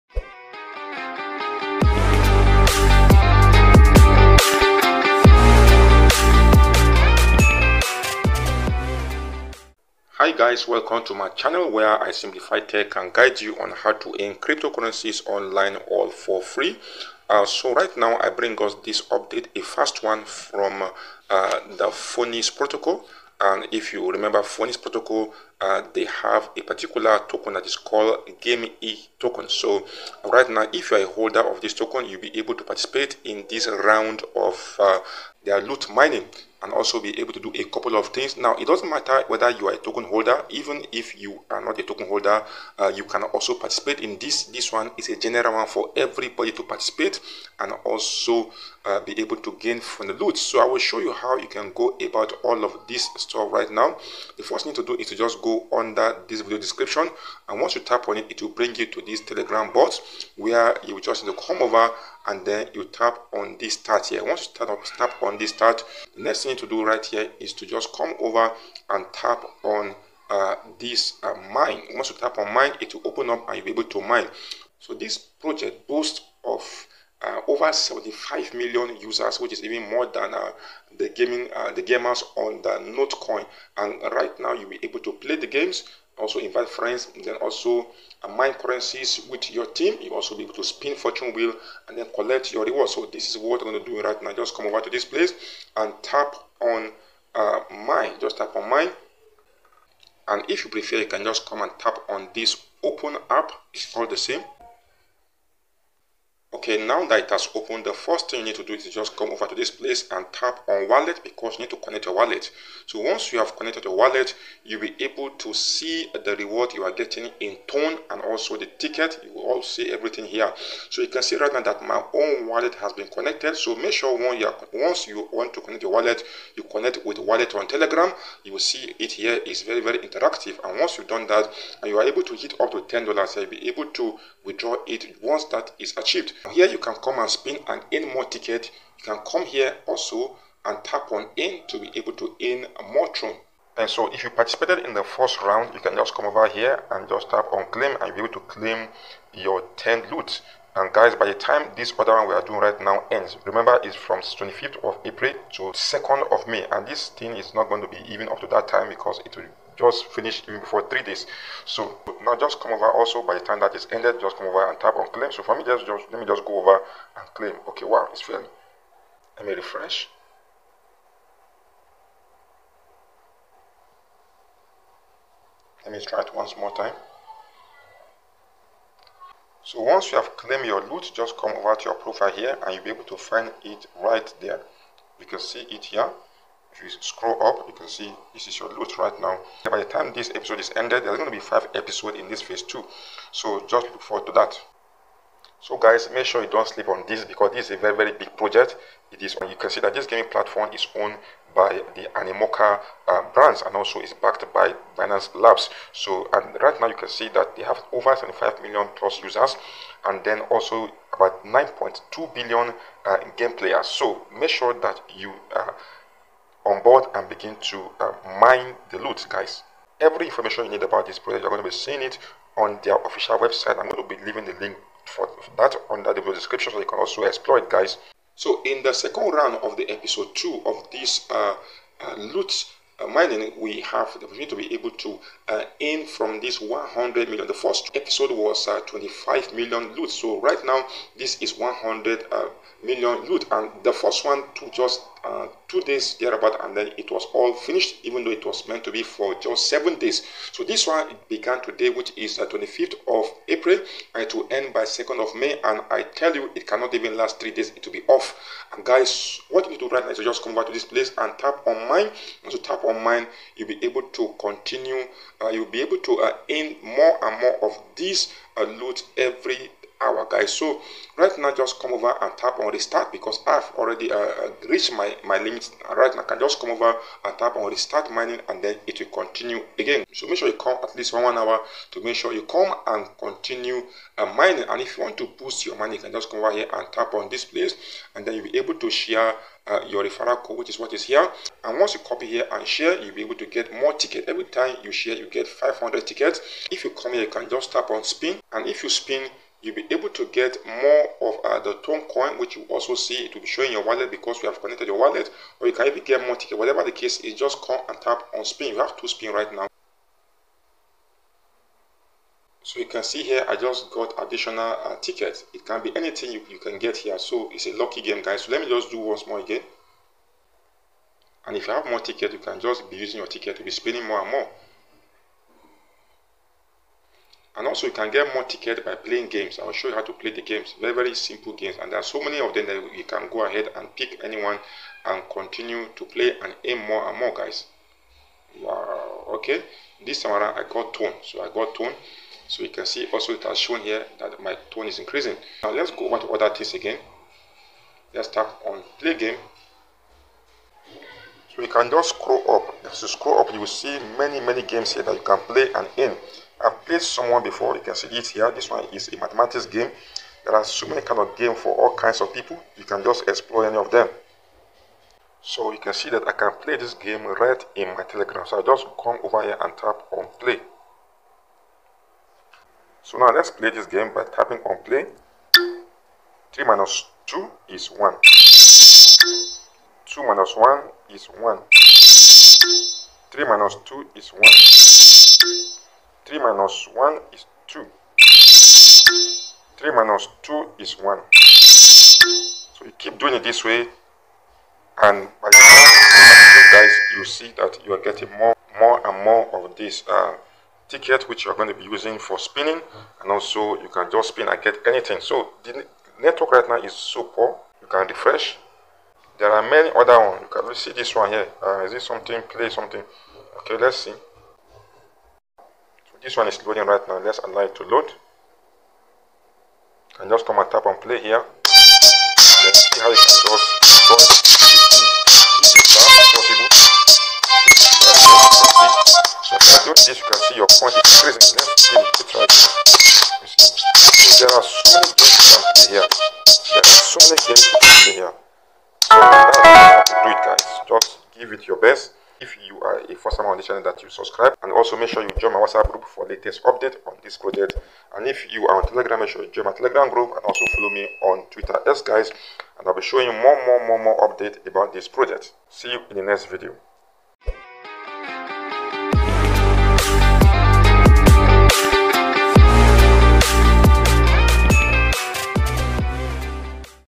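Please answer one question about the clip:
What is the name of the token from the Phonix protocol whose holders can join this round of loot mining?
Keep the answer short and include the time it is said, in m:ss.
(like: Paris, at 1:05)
game e token, at 0:28.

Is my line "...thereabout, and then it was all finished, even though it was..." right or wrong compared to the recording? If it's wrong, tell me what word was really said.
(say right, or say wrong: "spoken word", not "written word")
right.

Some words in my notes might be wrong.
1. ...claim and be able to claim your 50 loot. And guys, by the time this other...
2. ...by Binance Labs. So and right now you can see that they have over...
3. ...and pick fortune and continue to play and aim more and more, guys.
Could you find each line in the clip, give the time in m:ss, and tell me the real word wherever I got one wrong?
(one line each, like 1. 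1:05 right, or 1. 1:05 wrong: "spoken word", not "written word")
1. 2:27 wrong: "10", not "50"
2. 3:24 right
3. 5:33 wrong: "anyone", not "fortune".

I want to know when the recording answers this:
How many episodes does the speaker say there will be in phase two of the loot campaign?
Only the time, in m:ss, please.
3:11.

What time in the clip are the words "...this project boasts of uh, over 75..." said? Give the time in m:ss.
1:14.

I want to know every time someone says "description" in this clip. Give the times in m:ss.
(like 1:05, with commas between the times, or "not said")
0:56, 3:46.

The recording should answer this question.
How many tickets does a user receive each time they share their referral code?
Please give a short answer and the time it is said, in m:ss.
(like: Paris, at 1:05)
500, at 4:55.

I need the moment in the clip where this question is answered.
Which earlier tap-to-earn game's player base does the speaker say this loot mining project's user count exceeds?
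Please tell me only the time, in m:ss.
1:22.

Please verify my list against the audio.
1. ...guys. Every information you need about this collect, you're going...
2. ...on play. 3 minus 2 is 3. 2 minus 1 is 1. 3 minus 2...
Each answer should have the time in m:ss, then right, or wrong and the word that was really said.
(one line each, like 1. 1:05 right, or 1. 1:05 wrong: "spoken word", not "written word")
1. 3:39 wrong: "project", not "collect"
2. 6:14 wrong: "1", not "3".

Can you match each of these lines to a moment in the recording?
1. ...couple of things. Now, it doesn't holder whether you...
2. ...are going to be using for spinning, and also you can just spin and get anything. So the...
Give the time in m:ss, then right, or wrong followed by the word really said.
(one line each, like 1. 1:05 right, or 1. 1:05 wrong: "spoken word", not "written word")
1. 0:37 wrong: "matter", not "holder"
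2. 6:41 right.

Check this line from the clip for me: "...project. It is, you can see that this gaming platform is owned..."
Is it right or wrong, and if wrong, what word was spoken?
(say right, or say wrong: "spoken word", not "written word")
right.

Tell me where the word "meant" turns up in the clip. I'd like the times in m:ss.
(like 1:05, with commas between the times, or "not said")
4:08.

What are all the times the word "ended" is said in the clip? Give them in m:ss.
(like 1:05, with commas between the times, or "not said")
2:43, 3:10.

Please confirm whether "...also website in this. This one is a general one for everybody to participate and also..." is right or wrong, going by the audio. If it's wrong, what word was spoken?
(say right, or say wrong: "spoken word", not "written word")
wrong: "participate", not "website".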